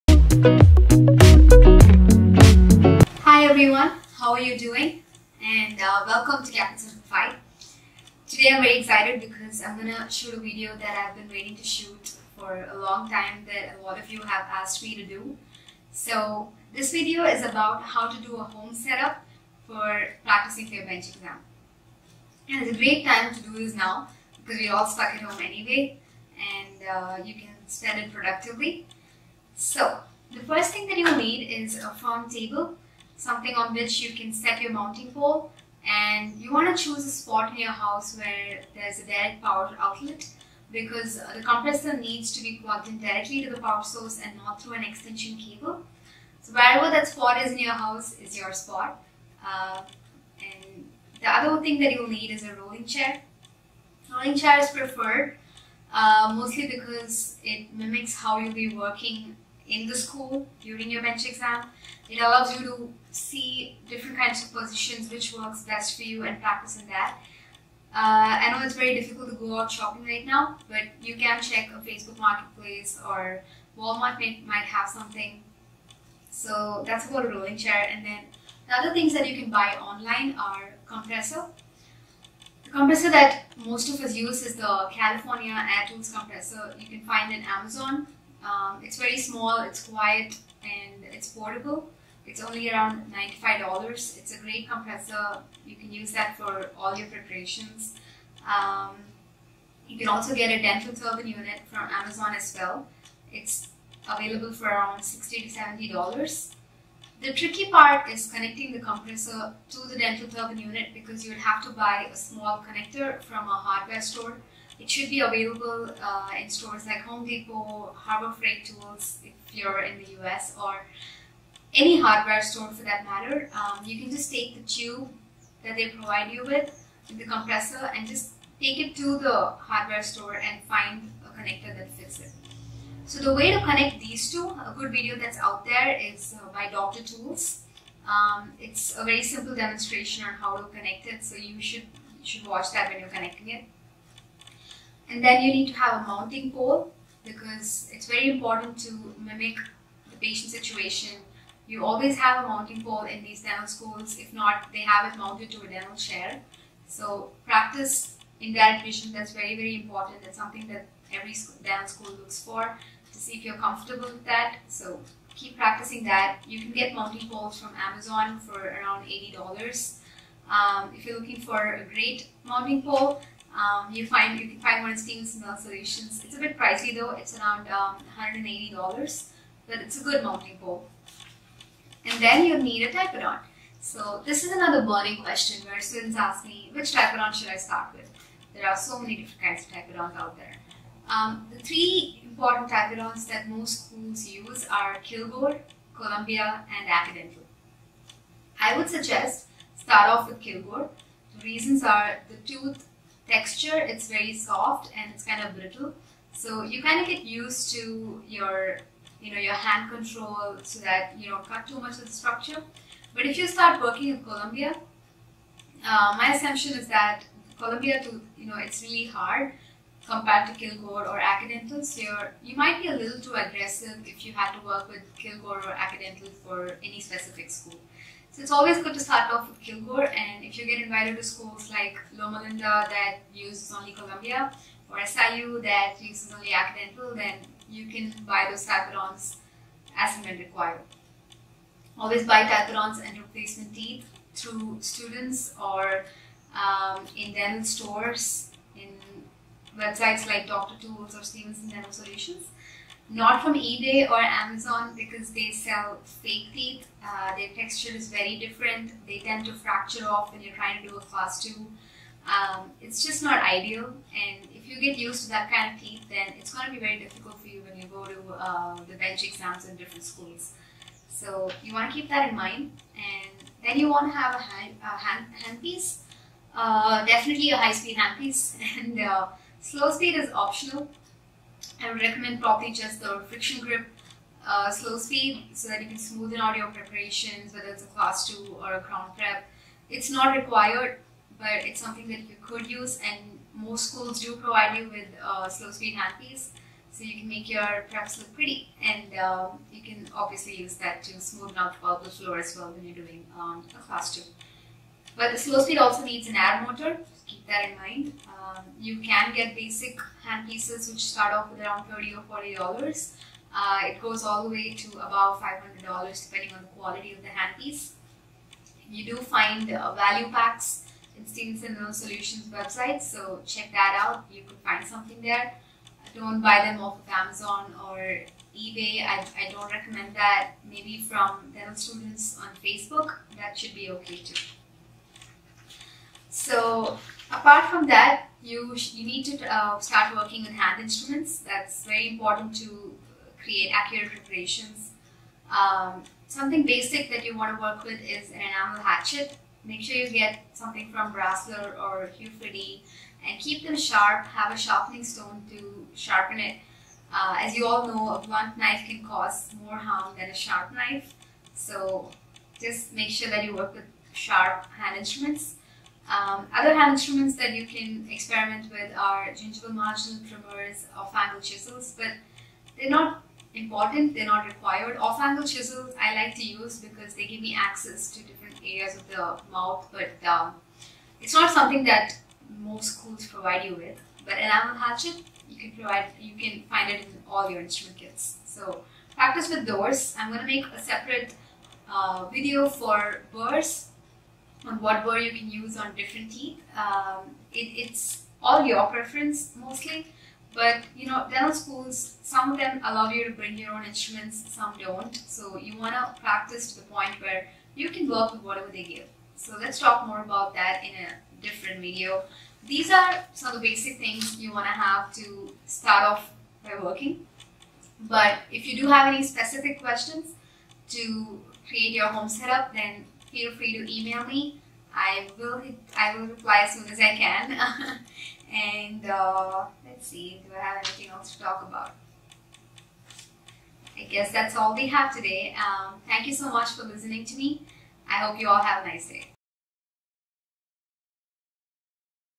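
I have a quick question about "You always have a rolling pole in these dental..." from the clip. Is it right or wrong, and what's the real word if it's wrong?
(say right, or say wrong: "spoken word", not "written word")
wrong: "mounting", not "rolling".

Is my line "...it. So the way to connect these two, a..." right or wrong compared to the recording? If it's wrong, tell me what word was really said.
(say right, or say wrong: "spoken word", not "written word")
right.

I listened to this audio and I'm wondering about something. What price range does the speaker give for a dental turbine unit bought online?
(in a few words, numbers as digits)
$60 to $70.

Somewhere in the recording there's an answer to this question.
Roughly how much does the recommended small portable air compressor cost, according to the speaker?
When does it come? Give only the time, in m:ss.
1:33.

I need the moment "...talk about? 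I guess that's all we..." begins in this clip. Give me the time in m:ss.
7:11.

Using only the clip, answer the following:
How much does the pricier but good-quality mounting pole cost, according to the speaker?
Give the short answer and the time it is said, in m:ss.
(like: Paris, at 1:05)
$180, at 2:58.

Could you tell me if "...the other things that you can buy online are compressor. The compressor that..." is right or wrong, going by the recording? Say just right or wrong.
right.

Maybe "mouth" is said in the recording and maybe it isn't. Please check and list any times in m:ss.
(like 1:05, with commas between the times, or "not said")
6:19.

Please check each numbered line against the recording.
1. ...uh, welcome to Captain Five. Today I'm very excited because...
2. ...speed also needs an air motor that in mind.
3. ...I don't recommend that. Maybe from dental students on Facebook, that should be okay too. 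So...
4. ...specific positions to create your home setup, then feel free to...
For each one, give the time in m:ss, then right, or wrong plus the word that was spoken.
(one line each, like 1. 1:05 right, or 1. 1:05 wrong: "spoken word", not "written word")
1. 0:05 right
2. 5:05 right
3. 5:29 right
4. 6:59 wrong: "questions", not "positions".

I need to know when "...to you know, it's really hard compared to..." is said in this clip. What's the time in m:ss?
3:38.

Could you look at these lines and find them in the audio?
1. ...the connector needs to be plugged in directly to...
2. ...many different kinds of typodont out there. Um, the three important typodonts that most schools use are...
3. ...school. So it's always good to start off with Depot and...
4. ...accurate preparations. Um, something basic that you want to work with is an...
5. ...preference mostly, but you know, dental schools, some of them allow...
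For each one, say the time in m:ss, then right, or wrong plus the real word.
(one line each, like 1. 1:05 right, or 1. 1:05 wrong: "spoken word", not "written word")
1. 0:41 wrong: "compressor", not "connector"
2. 3:08 right
3. 3:47 wrong: "Kilgore", not "Depot"
4. 5:43 right
5. 6:38 right.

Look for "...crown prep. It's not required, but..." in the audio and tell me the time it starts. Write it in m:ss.
4:48.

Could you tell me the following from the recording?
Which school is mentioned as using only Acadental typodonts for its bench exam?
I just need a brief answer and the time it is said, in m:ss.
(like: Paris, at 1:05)
SIU, at 3:55.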